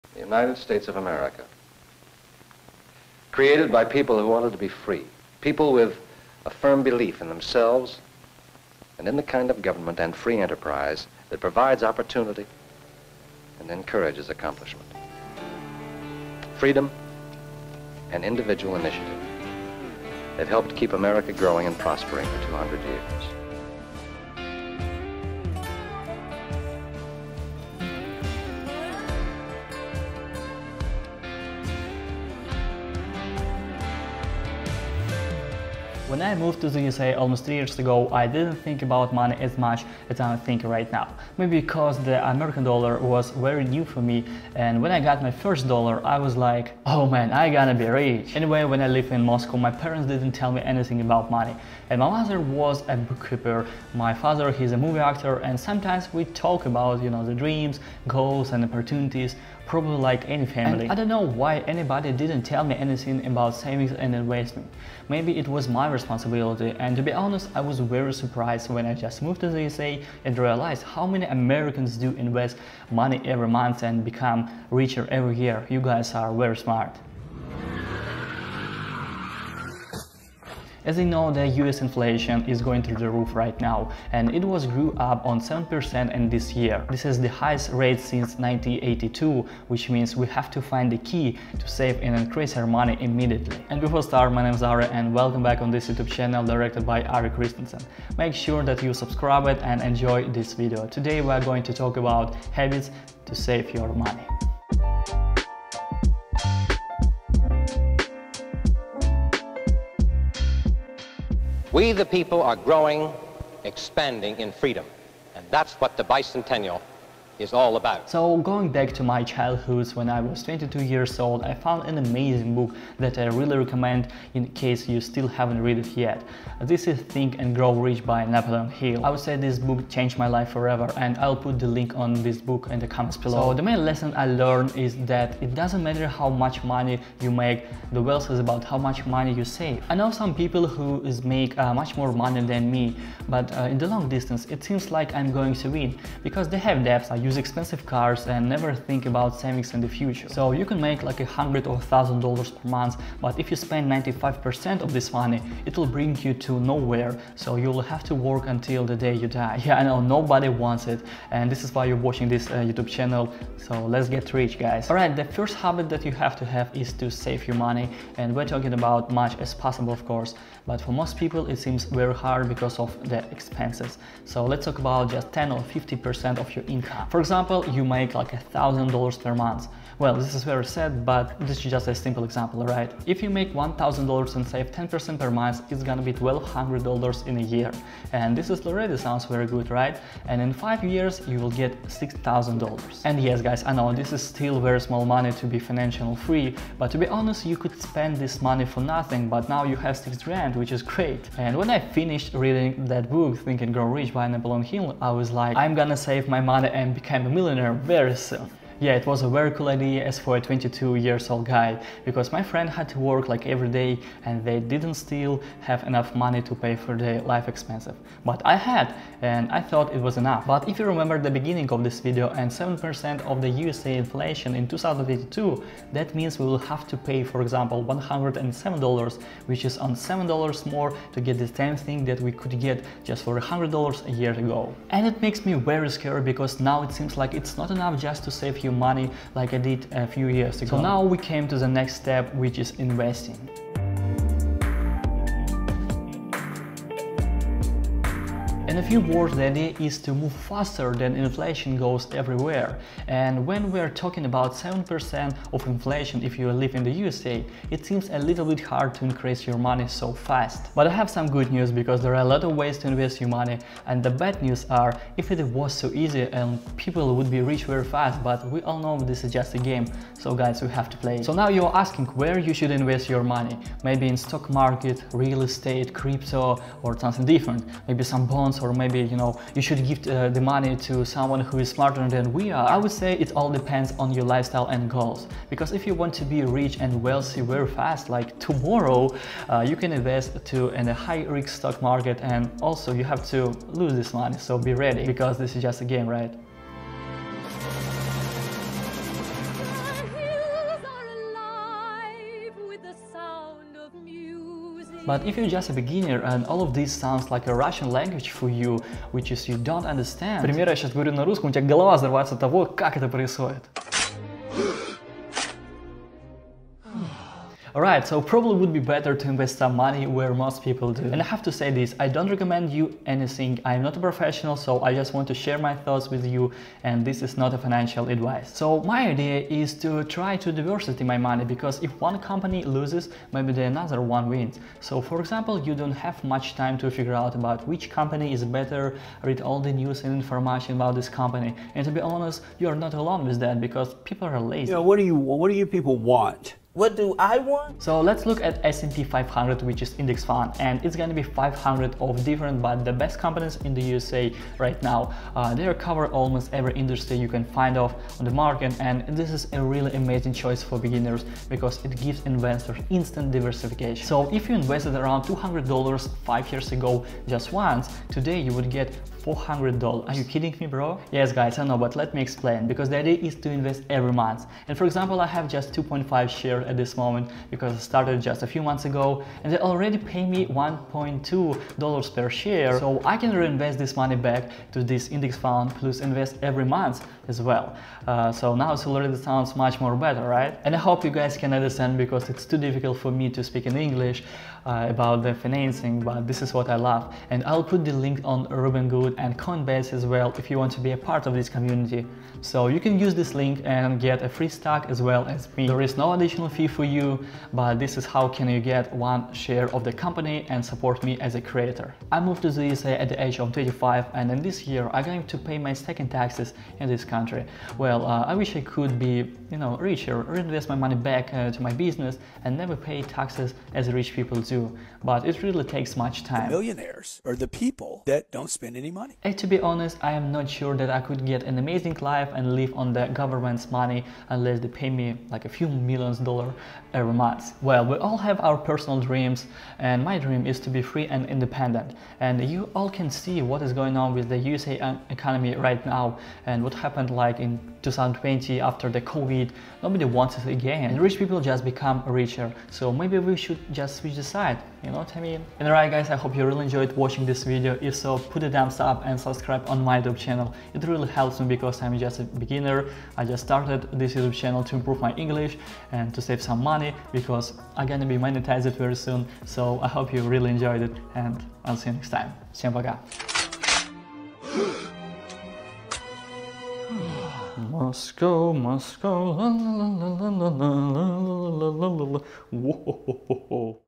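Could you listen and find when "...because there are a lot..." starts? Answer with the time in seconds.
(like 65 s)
261 s.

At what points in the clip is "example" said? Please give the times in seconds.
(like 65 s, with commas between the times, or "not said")
177 s, 182 s, 227 s, 335 s, 374 s.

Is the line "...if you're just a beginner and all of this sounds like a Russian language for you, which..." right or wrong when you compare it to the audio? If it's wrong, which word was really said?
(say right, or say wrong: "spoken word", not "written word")
right.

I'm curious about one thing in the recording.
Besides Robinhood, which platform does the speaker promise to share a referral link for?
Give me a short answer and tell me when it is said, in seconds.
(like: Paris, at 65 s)
Coinbase, at 399 s.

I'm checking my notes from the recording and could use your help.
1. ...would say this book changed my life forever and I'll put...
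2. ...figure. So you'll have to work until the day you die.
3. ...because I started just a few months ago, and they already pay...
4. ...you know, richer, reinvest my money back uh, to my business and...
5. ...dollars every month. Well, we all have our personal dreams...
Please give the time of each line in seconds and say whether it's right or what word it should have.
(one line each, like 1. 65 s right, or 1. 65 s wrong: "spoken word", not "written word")
1. 129 s right
2. 156 s wrong: "nowhere", not "figure"
3. 377 s right
4. 419 s right
5. 436 s right.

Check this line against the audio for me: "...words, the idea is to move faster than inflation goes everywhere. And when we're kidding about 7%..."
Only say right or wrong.
wrong.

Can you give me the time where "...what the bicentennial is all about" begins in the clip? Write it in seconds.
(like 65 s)
115 s.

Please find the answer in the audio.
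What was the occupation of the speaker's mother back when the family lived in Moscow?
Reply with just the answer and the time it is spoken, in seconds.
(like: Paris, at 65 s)
Bookkeeper, at 52 s.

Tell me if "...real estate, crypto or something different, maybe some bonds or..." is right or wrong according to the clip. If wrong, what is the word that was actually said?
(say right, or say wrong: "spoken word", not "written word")
right.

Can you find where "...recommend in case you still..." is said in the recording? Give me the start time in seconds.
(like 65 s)
123 s.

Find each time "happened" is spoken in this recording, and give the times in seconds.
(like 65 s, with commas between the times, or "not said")
446 s.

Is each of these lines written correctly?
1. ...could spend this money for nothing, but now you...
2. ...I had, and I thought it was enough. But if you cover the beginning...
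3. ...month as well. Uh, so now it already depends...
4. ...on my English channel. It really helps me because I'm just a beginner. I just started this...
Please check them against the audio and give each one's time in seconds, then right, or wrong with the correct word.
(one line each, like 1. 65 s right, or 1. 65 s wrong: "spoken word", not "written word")
1. 197 s right
2. 218 s wrong: "remember", not "cover"
3. 386 s wrong: "sounds", not "depends"
4. 459 s wrong: "YouTube", not "English".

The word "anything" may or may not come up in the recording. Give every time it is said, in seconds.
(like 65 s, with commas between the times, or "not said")
50 s, 62 s, 323 s.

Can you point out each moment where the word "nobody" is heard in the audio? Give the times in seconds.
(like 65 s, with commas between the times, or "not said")
160 s, 449 s.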